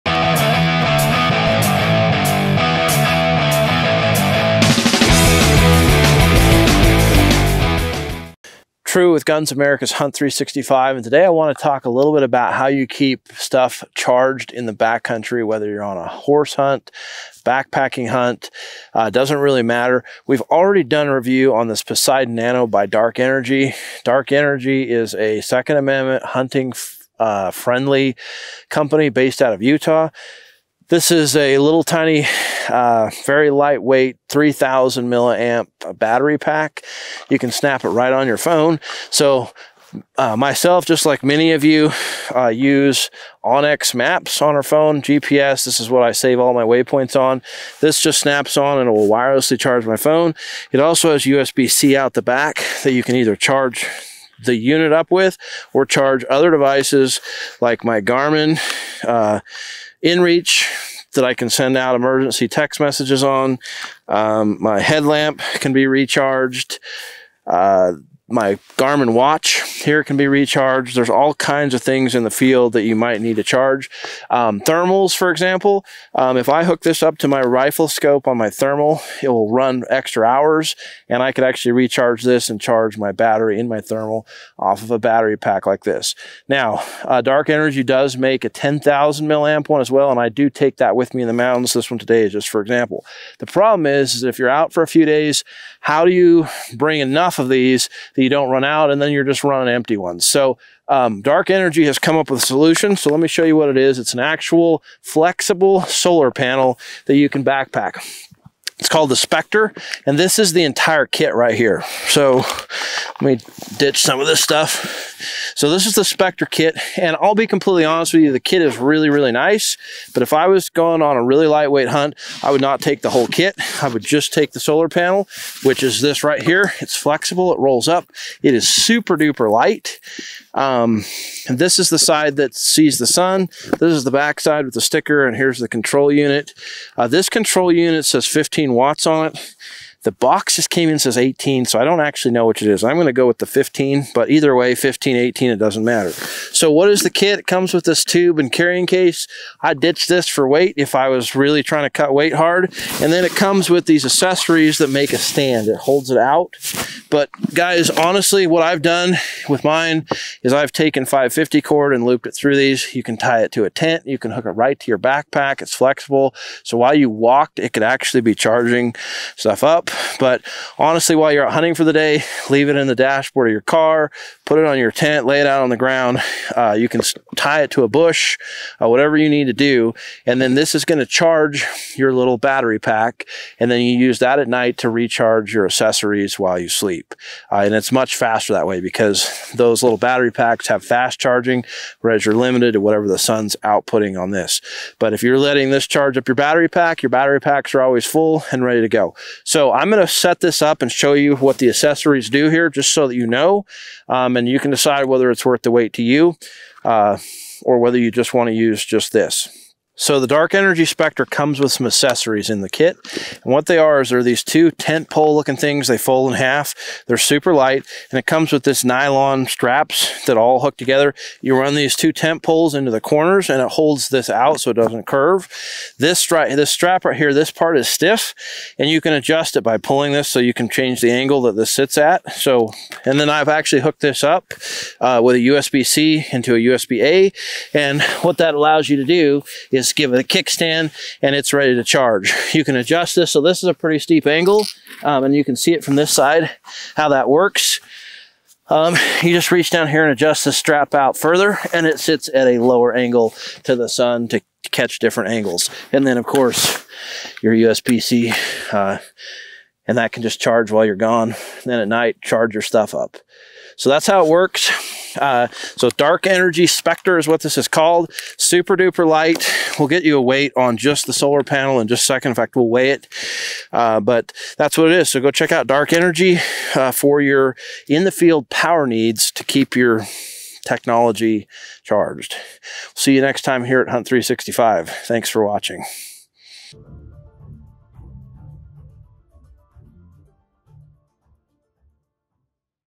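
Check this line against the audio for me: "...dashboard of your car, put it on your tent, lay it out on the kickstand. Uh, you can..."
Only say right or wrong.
wrong.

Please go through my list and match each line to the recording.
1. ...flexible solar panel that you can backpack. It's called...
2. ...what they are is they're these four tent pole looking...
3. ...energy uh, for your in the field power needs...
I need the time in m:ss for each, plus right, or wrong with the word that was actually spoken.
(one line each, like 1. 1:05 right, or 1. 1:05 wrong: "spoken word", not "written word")
1. 1:45 right
2. 3:33 wrong: "two", not "four"
3. 4:35 right.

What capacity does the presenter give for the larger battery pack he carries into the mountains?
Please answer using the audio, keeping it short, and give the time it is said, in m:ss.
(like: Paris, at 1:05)
10,000 milliamp, at 1:28.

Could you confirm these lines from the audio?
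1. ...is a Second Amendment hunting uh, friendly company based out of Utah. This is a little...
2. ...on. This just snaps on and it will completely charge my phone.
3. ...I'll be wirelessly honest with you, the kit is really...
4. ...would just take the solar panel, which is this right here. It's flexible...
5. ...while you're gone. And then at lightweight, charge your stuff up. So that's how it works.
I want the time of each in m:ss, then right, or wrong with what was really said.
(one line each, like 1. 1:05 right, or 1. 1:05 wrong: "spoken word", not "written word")
1. 0:24 right
2. 0:47 wrong: "wirelessly", not "completely"
3. 1:57 wrong: "completely", not "wirelessly"
4. 2:03 right
5. 4:20 wrong: "night", not "lightweight".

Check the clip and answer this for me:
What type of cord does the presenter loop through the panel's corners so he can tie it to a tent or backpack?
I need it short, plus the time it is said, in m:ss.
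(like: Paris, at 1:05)
550 cord, at 2:41.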